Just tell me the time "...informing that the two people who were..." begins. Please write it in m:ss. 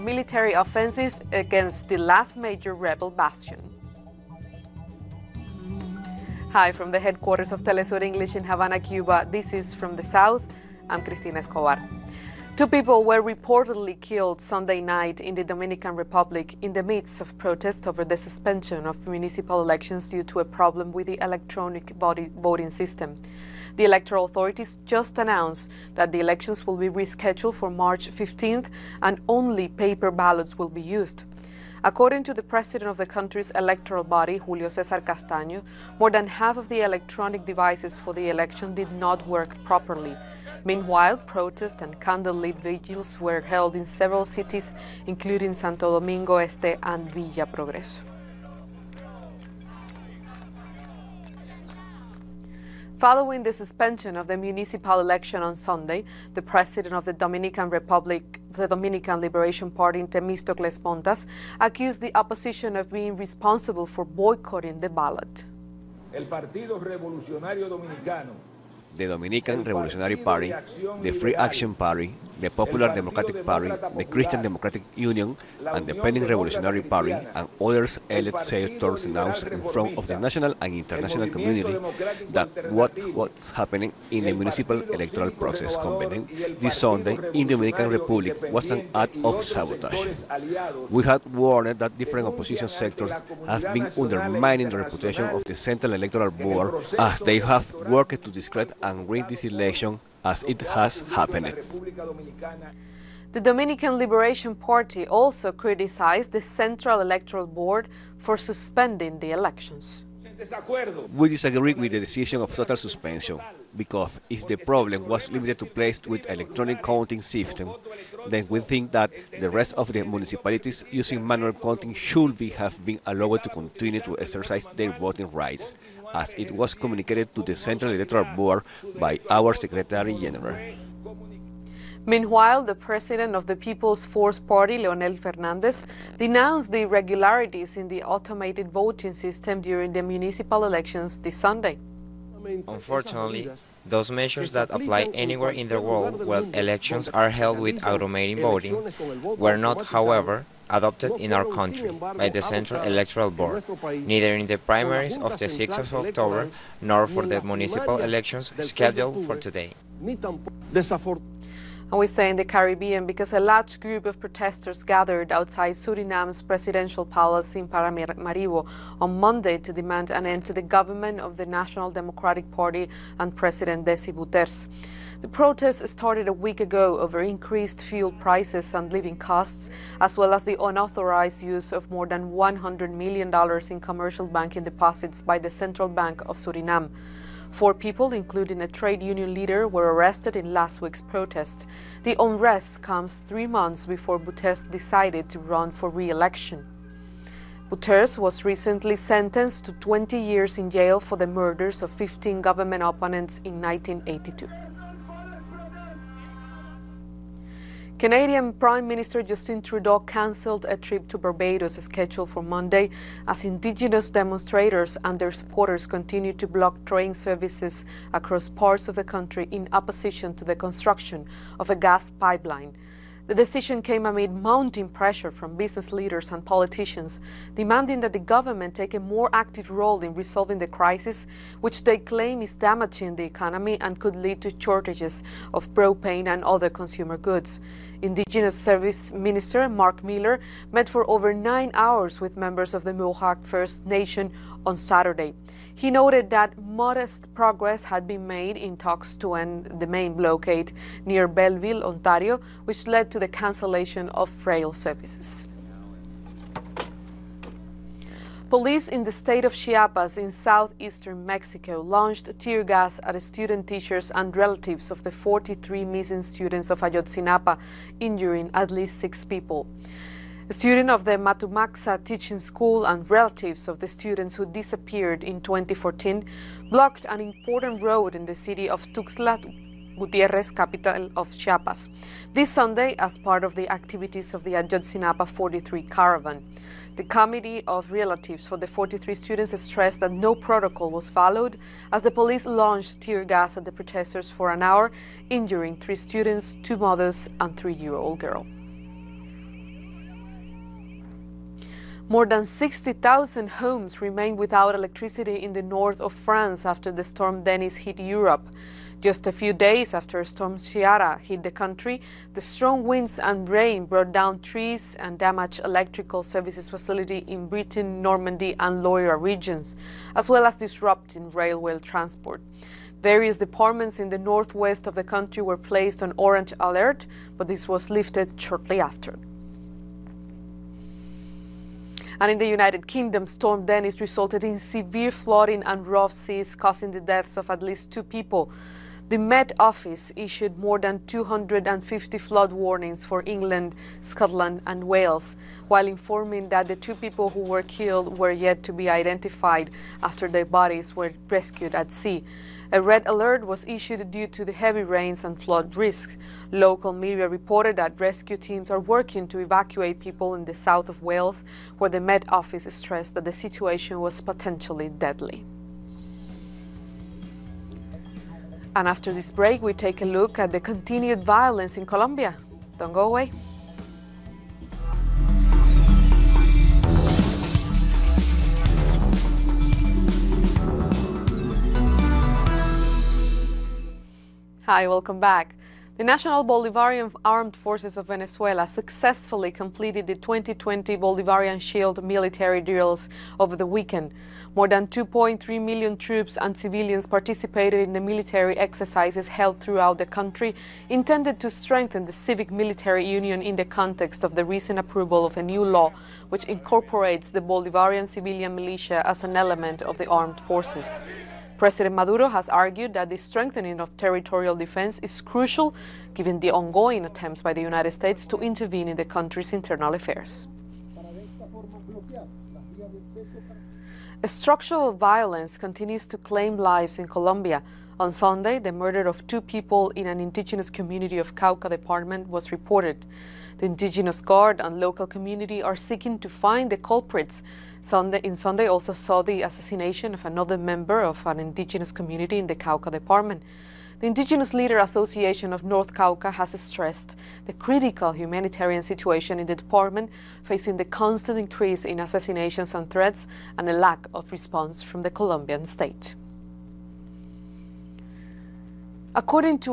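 5:45.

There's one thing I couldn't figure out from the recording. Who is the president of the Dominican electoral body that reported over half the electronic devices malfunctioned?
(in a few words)
Julio Cesar Castaño.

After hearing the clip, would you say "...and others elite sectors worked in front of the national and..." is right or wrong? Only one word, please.
wrong.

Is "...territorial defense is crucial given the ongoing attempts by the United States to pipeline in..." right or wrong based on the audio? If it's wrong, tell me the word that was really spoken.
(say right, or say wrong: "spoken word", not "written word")
wrong: "intervene", not "pipeline".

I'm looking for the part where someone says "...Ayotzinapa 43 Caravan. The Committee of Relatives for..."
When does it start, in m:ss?
4:44.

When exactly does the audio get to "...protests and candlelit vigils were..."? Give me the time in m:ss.
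0:41.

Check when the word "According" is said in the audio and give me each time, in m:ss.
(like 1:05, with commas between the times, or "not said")
0:31, 7:39.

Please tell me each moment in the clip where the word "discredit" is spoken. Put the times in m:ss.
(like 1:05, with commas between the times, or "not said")
1:38.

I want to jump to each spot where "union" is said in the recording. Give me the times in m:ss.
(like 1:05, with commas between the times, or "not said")
1:14, 3:09, 6:43.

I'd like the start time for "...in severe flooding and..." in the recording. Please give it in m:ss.
5:34.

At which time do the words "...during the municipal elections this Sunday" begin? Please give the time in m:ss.
2:19.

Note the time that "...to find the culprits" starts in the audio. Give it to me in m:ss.
7:16.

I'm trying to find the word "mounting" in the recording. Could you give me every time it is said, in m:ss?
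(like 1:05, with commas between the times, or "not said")
3:44.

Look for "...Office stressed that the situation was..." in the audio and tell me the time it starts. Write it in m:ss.
6:02.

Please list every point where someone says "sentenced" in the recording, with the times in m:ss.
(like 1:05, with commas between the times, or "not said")
3:18.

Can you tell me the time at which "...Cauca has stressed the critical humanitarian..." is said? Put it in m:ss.
7:25.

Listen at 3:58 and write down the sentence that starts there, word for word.
Indigenous Service Minister Mark Miller met for over nine hours with members of the Mohawk First Nation on Saturday.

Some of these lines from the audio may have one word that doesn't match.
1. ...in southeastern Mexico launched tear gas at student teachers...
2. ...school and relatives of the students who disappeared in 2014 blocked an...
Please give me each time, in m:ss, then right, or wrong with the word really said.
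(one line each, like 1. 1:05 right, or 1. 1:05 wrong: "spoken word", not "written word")
1. 4:20 right
2. 4:32 right.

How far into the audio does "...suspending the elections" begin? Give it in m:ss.
1:48.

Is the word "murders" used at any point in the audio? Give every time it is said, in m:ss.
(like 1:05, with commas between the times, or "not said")
3:21, 7:08.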